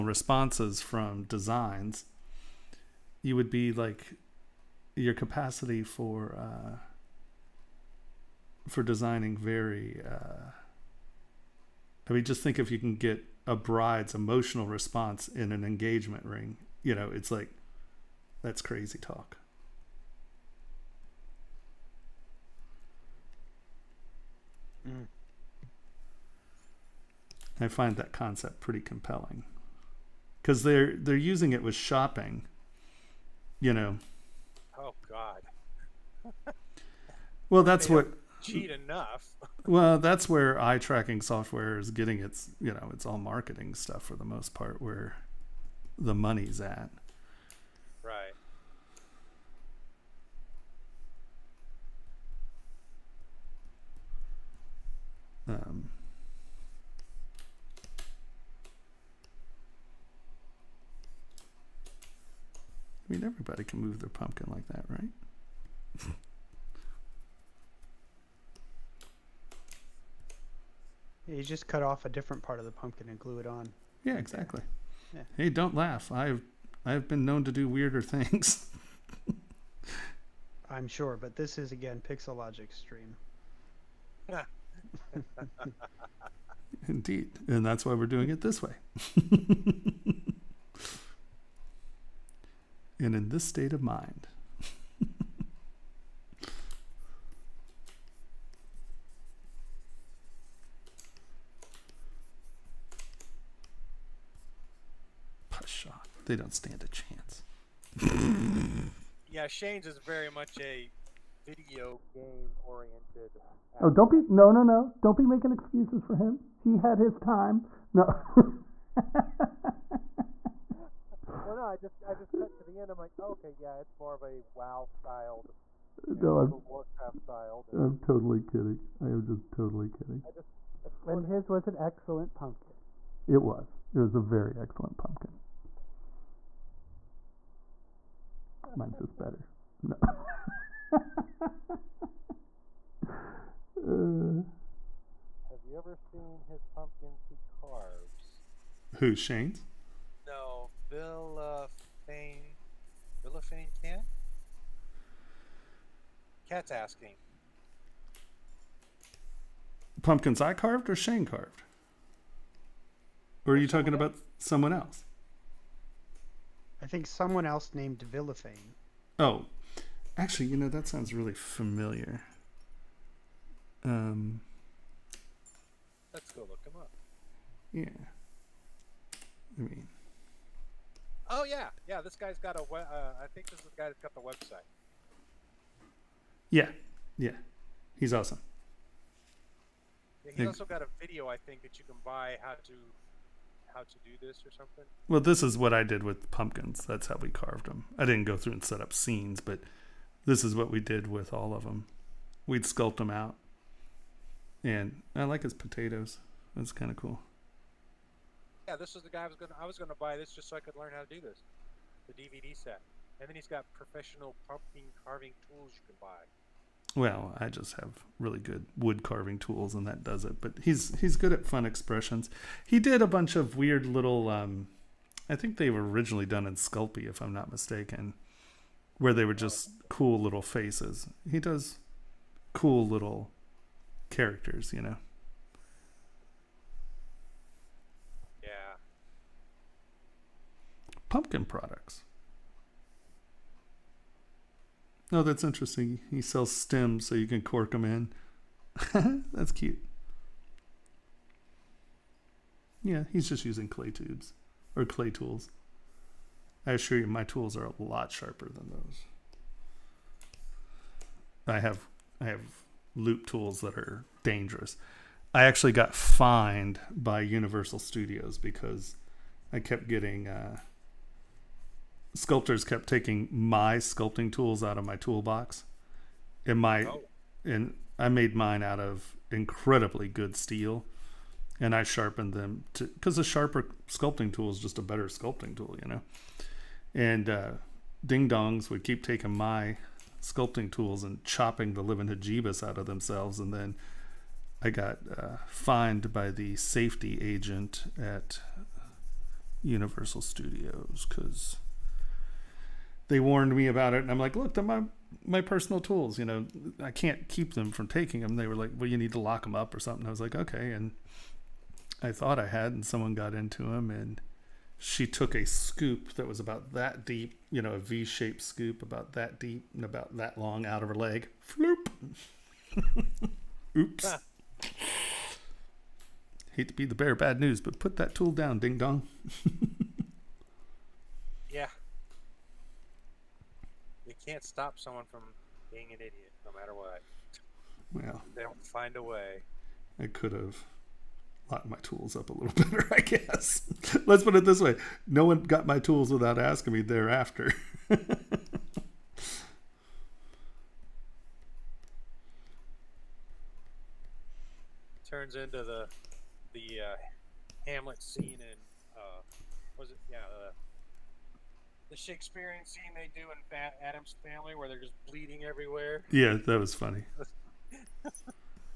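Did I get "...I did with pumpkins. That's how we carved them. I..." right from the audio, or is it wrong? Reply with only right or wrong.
right.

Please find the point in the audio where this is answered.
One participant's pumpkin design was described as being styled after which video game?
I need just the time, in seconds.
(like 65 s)
126 s.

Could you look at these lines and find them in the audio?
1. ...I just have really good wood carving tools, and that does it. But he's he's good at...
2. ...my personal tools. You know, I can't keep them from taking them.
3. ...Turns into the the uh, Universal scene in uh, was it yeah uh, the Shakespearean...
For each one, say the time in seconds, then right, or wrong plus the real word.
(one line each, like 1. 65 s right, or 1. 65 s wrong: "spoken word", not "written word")
1. 217 s right
2. 305 s right
3. 355 s wrong: "Hamlet", not "Universal".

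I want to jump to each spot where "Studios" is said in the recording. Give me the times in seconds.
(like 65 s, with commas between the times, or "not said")
267 s, 300 s.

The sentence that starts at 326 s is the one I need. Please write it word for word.
Hate to be the bear, bad news, but put that tool down, ding dong.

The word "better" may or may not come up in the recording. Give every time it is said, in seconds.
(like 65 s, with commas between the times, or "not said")
139 s, 284 s, 342 s.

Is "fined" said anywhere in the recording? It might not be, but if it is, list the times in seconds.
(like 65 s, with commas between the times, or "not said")
265 s, 295 s.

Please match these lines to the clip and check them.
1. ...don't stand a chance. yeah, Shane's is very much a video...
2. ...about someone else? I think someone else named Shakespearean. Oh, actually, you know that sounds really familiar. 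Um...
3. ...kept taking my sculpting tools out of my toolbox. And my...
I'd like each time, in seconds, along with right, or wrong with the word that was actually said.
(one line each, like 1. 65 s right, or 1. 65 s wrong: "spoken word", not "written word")
1. 106 s right
2. 163 s wrong: "Villafane", not "Shakespearean"
3. 272 s right.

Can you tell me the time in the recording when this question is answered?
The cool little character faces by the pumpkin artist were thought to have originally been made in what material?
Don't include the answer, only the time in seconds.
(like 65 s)
226 s.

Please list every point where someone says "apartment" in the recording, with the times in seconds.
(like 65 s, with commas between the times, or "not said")
not said.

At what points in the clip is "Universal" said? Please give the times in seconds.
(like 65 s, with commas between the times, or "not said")
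267 s, 299 s.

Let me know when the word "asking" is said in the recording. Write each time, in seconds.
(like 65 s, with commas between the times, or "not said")
156 s, 346 s.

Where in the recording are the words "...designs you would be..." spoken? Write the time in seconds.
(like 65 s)
1 s.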